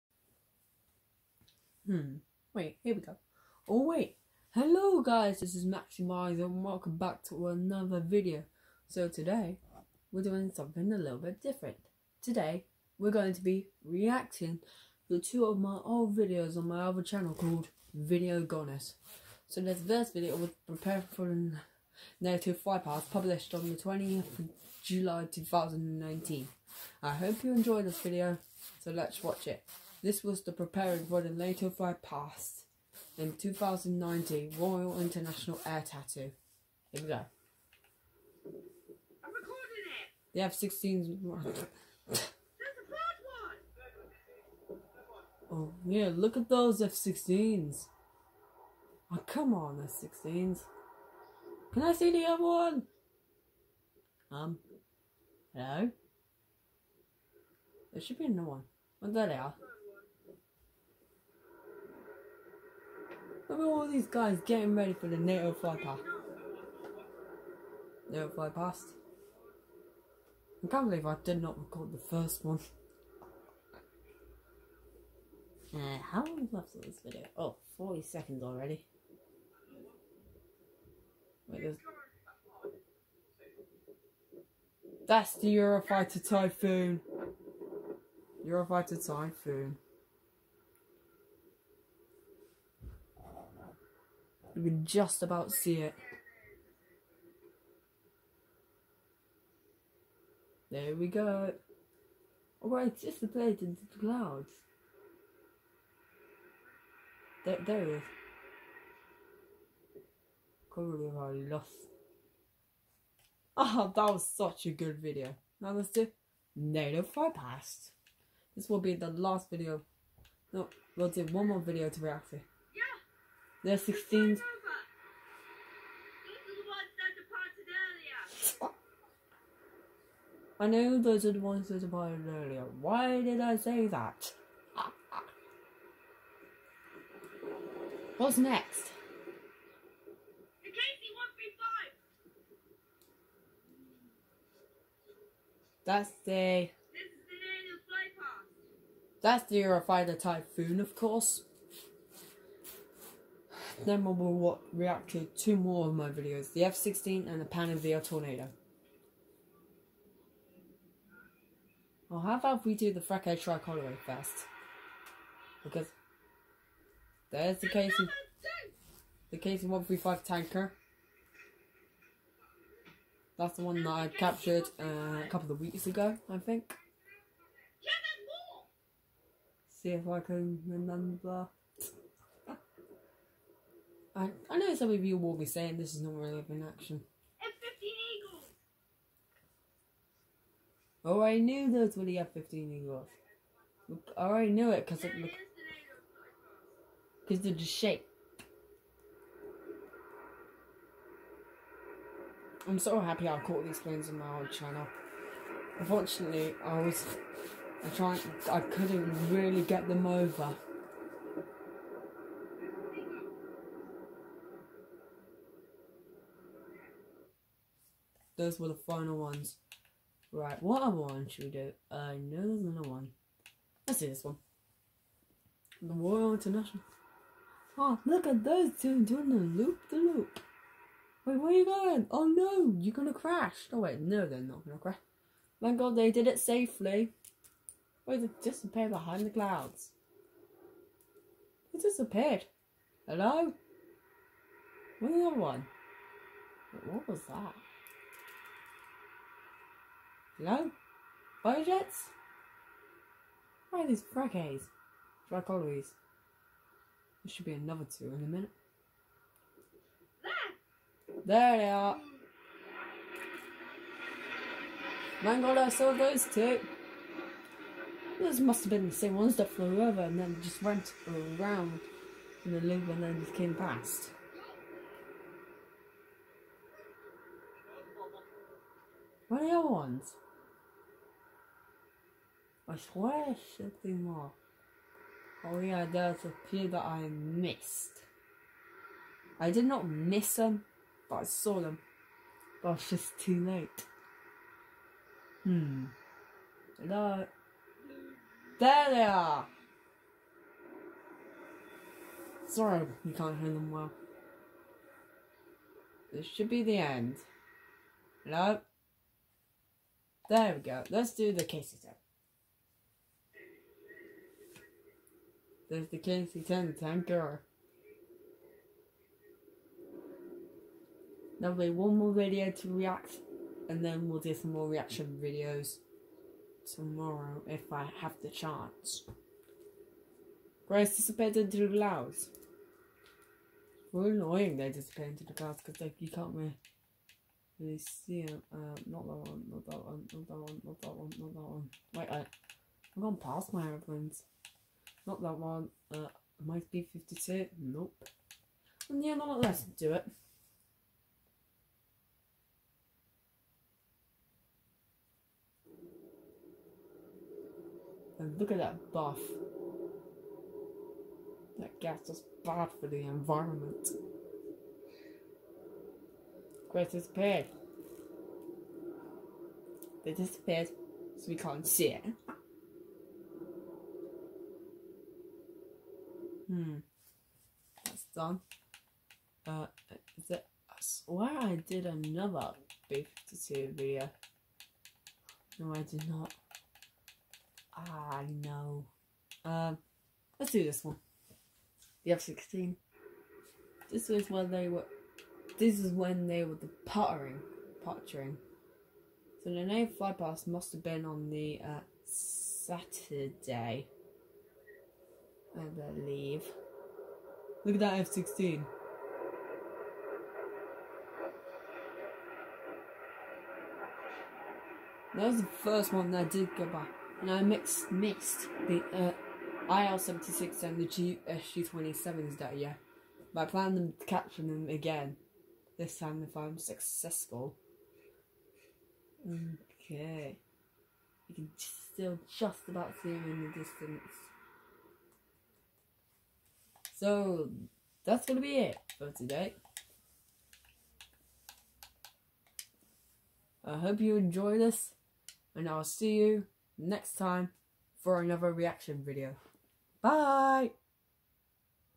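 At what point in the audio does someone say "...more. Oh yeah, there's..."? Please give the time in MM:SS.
04:44.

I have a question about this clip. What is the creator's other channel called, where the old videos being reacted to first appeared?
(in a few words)
Video Goddess.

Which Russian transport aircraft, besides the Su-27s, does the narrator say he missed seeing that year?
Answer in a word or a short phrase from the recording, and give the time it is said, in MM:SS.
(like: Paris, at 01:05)
IL-76, at 06:59.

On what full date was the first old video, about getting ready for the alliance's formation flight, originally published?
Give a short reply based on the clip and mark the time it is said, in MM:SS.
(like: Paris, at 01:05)
20 July 2019, at 00:23.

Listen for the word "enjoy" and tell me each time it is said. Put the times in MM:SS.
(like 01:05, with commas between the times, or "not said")
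00:27, 07:24.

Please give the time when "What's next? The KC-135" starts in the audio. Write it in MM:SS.
02:18.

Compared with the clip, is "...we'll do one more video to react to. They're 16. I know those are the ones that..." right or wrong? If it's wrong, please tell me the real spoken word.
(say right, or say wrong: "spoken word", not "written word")
right.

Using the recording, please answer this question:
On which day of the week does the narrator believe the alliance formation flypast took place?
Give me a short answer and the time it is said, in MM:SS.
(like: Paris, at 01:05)
Saturday, at 06:42.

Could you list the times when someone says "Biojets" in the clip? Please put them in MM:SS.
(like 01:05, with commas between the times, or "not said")
04:11.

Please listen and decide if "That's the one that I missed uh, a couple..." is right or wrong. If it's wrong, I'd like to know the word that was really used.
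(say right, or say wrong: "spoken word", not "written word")
wrong: "captured", not "missed".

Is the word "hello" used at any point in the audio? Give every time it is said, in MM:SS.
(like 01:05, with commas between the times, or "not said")
00:04, 00:55, 04:03, 04:10, 04:56, 05:08.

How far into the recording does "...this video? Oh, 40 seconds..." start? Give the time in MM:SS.
01:16.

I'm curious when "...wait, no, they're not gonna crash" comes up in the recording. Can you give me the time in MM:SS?
03:53.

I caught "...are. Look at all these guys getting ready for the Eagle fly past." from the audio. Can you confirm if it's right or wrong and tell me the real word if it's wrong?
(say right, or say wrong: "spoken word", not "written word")
wrong: "NATO", not "Eagle".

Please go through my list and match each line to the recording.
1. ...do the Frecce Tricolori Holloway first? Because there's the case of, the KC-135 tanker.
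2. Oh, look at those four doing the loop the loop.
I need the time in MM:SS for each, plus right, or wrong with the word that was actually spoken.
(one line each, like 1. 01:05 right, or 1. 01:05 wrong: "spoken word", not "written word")
1. 02:42 right
2. 03:47 wrong: "two", not "four".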